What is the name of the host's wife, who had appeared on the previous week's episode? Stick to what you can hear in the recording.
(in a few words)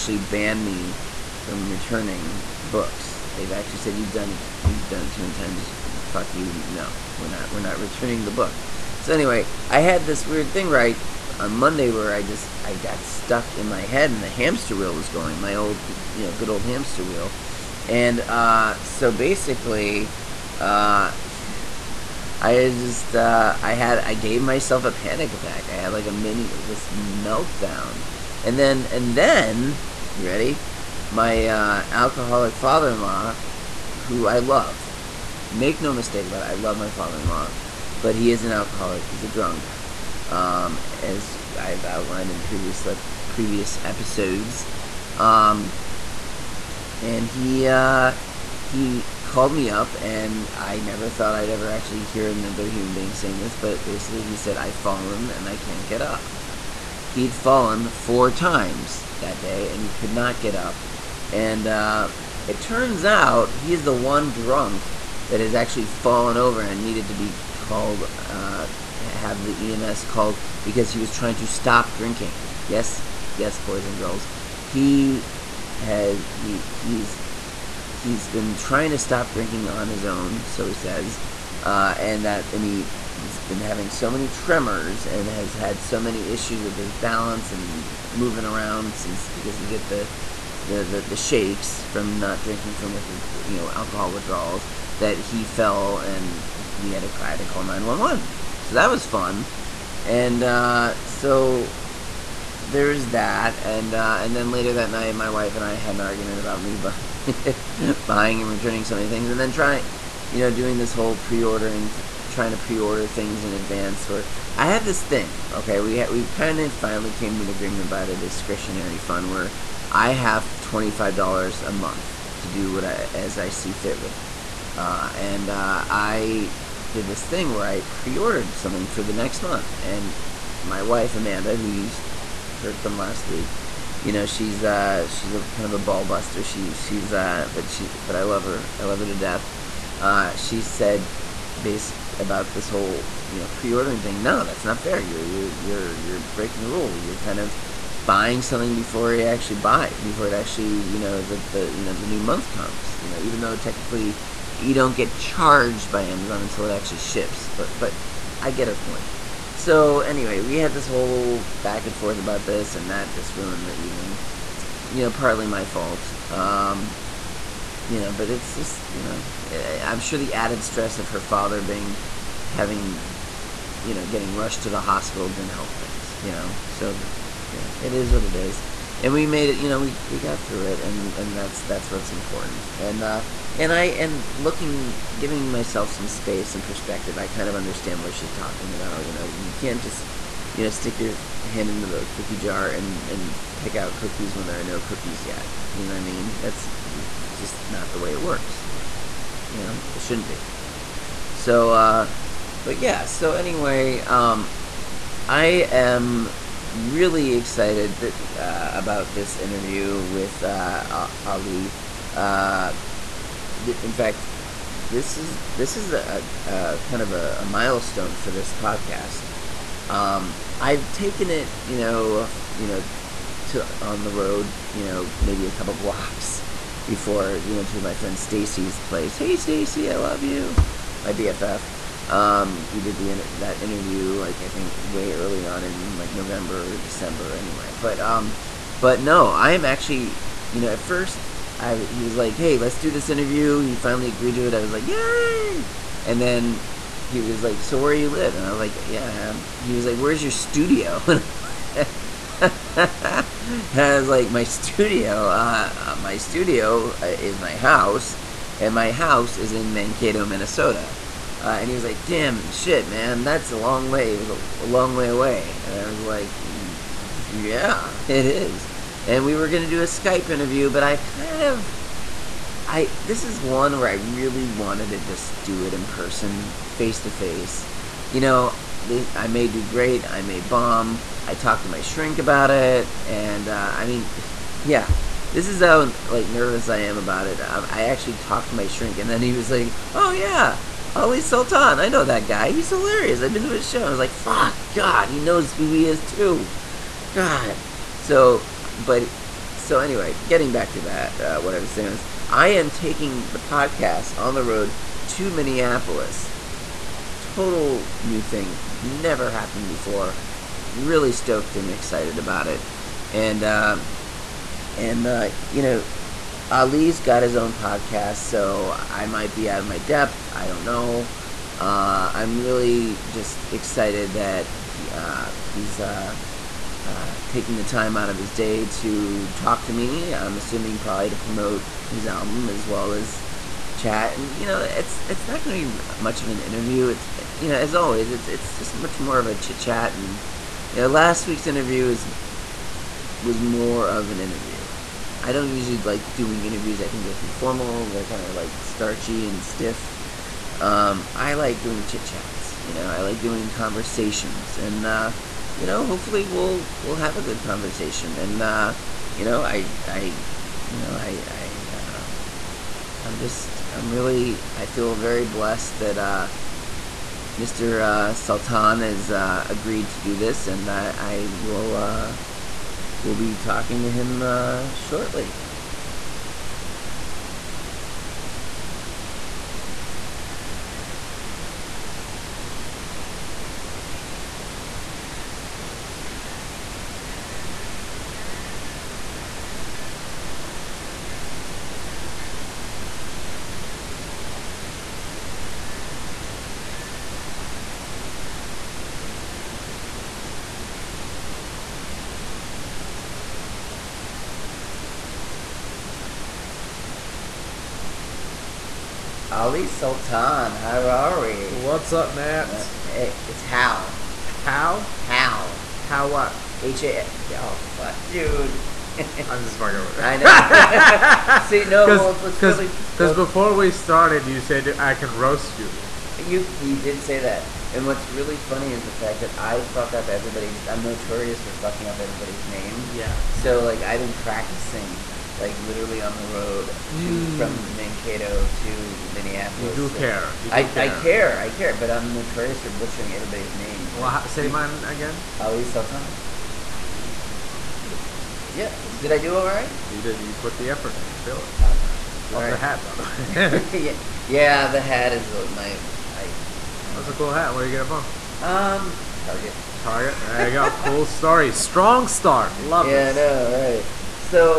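Amanda.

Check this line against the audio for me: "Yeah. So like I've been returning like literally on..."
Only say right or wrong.
wrong.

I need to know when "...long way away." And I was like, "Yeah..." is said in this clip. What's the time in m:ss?
4:24.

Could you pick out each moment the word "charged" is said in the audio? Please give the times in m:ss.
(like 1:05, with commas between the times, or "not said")
2:35.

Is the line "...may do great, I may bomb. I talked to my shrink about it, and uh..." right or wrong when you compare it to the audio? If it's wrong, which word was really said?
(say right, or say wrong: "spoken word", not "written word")
right.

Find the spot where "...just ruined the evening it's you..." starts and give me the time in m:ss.
2:43.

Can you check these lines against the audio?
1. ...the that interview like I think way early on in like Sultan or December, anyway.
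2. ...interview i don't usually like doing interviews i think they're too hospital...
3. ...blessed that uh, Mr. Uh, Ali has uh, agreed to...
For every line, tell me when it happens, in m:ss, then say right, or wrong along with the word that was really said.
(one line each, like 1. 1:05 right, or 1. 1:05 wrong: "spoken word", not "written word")
1. 3:52 wrong: "November", not "Sultan"
2. 5:44 wrong: "formal", not "hospital"
3. 6:05 wrong: "Sultan", not "Ali".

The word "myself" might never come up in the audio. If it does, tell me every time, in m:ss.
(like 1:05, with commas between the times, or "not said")
0:24, 3:05.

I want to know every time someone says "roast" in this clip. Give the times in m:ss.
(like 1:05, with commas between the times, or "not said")
7:05.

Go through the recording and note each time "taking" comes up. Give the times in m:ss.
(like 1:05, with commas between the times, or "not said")
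5:02, 5:27.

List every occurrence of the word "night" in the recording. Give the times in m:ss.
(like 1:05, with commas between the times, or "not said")
1:44.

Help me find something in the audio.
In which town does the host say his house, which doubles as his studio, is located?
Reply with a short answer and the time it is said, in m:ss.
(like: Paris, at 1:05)
Mankato, Minnesota, at 4:19.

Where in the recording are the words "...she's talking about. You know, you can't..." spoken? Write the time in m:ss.
3:08.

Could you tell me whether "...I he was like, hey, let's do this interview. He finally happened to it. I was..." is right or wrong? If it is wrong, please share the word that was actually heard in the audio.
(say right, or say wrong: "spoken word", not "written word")
wrong: "agreed", not "happened".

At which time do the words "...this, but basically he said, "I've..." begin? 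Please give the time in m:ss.
0:53.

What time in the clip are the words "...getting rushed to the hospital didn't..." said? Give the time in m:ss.
2:54.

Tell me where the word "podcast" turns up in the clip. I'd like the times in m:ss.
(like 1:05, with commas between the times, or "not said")
3:38, 5:03, 5:17.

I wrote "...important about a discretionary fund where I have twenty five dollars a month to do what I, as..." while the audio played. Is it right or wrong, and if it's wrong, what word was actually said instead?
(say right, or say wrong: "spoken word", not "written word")
wrong: "agreement", not "important".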